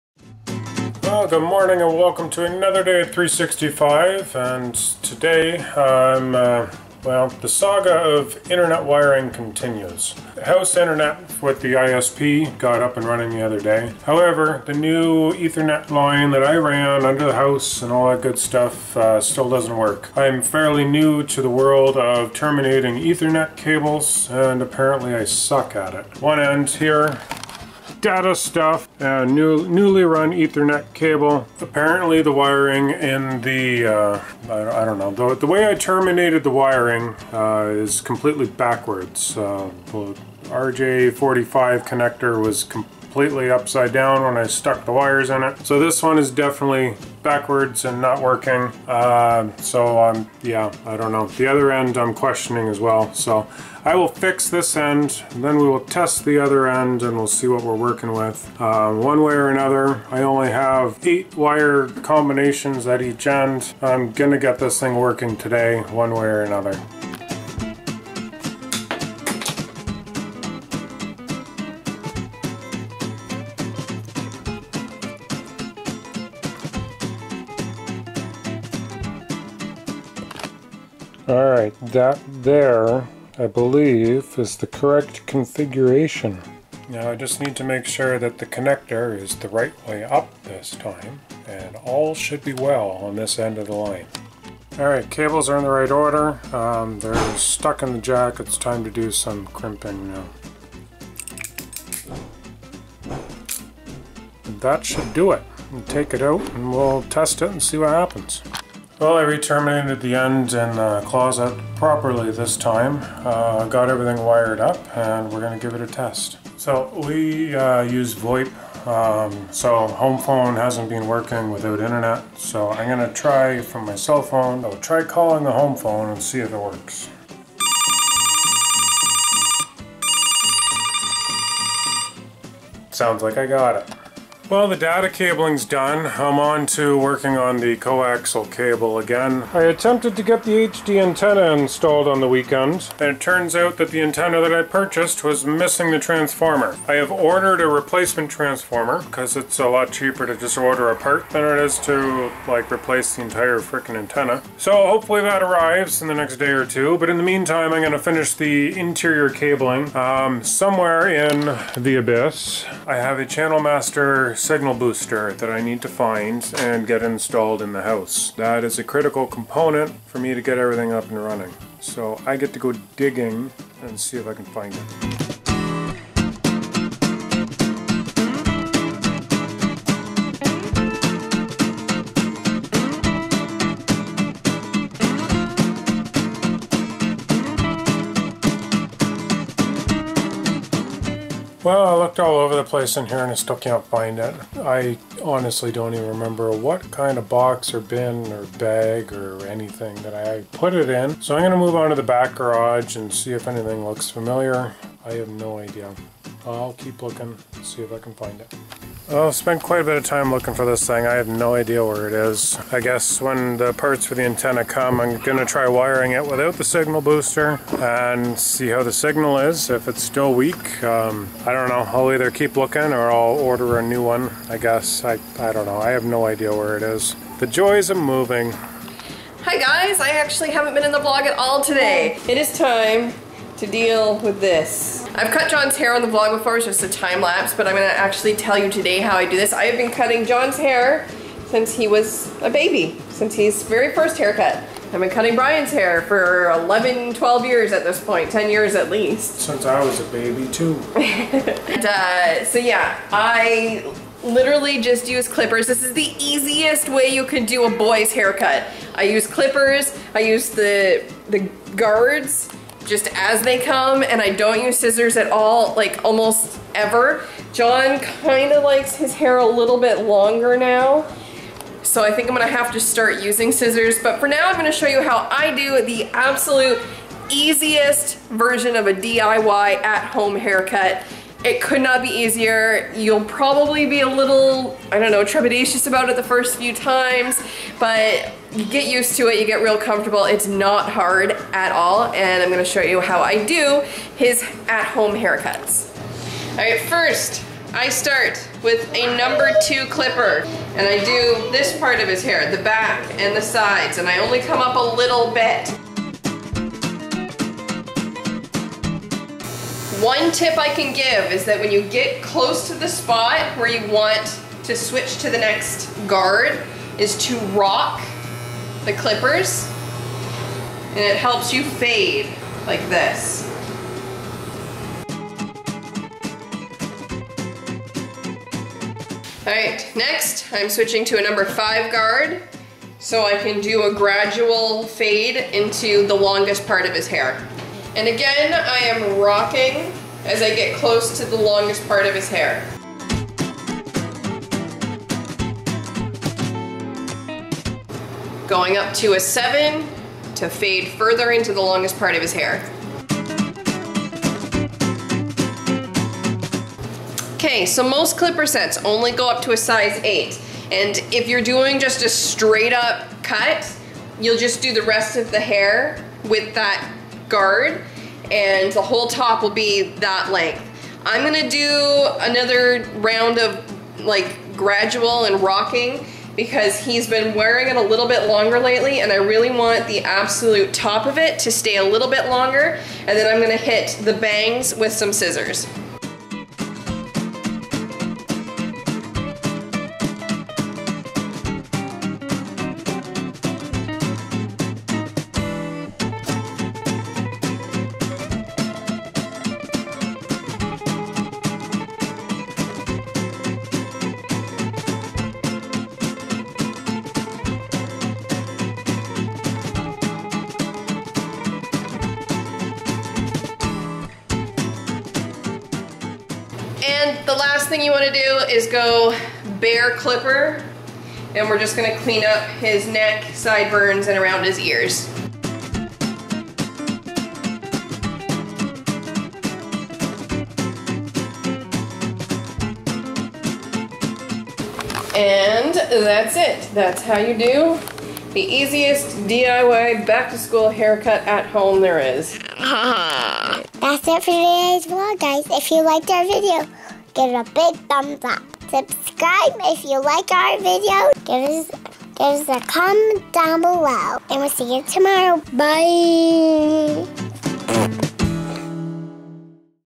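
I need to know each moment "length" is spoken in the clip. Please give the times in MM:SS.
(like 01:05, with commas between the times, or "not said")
06:10.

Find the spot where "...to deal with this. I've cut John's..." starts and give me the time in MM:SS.
03:53.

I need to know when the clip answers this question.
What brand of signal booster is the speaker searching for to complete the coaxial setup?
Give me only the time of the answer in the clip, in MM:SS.
02:43.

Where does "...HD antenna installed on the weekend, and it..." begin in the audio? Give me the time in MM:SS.
02:20.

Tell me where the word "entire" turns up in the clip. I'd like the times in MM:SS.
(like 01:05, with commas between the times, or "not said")
02:33.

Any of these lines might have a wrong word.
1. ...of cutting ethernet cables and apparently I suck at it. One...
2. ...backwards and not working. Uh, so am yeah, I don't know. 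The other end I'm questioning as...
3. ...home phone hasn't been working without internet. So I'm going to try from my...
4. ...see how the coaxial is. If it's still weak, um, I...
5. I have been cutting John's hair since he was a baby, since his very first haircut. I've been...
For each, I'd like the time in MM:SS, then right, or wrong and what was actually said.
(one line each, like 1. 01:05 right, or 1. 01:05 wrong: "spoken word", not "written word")
1. 00:21 wrong: "terminating", not "cutting"
2. 00:47 right
3. 01:59 right
4. 03:38 wrong: "signal", not "coaxial"
5. 03:59 right.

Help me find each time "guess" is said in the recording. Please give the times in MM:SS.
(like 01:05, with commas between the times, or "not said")
03:32, 03:44.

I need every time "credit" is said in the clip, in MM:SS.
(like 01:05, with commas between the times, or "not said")
not said.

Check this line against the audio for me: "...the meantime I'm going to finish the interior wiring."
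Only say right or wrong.
wrong.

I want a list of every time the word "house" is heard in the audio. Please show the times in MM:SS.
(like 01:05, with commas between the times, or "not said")
00:10, 00:17, 02:47.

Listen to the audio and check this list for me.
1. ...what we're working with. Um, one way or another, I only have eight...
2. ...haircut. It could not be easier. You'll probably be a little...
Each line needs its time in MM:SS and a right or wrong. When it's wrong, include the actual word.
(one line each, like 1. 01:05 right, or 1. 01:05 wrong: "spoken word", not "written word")
1. 00:57 right
2. 04:40 right.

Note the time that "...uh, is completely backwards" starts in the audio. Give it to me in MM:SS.
00:37.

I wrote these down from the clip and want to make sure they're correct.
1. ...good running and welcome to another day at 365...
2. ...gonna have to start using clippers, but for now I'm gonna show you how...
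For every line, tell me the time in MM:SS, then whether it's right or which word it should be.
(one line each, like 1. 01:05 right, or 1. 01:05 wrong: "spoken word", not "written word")
1. 00:01 wrong: "morning", not "running"
2. 04:32 wrong: "scissors", not "clippers".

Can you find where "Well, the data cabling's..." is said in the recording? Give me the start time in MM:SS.
02:14.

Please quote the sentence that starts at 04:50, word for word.
It's not hard at all, and I'm gonna show you how I do his at-home haircuts.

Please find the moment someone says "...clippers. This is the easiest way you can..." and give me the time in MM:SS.
04:15.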